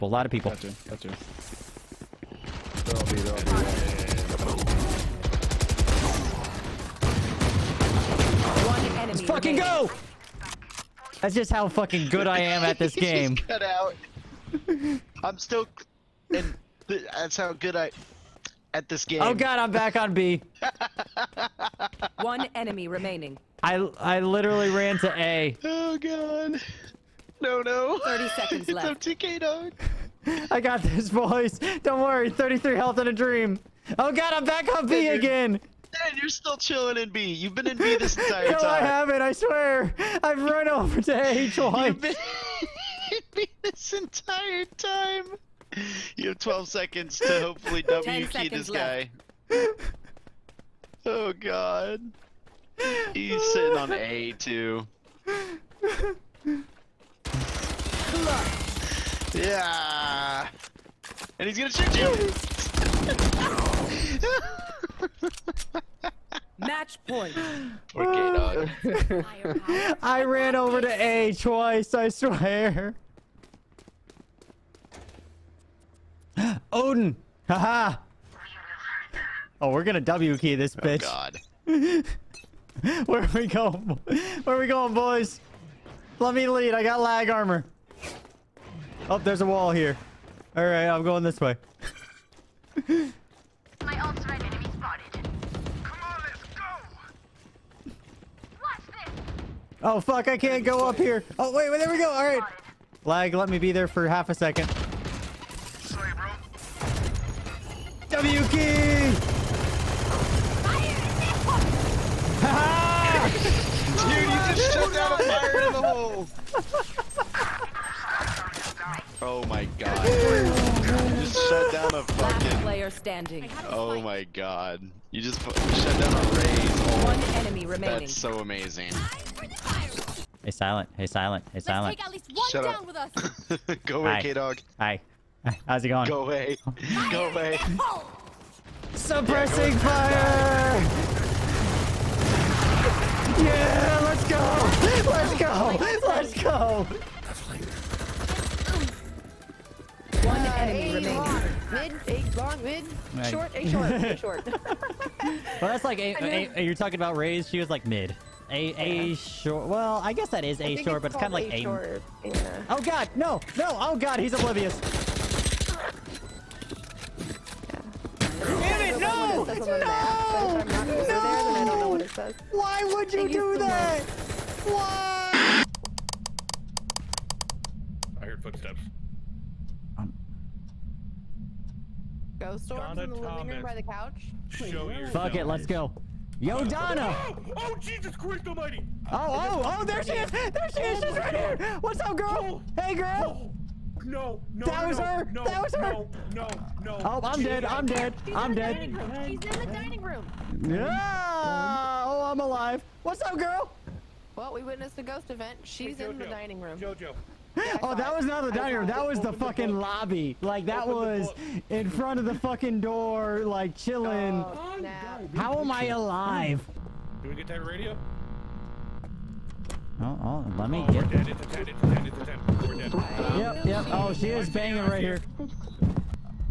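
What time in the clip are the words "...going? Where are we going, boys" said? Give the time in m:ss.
1:23.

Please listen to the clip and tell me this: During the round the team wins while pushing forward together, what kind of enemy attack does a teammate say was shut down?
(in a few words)
a raid.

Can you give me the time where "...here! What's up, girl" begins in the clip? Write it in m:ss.
3:11.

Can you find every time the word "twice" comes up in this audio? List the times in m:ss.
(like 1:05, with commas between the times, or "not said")
0:41, 1:11.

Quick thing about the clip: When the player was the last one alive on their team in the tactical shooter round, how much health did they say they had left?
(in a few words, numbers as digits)
33.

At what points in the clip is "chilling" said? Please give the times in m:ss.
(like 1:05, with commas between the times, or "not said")
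0:36, 3:33.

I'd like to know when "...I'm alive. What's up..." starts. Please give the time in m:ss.
3:22.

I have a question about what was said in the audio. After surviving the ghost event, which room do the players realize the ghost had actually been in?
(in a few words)
the lobby.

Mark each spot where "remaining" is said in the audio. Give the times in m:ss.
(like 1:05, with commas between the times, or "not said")
0:22, 2:07, 2:30.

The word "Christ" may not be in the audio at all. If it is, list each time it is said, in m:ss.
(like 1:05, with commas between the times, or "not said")
3:08.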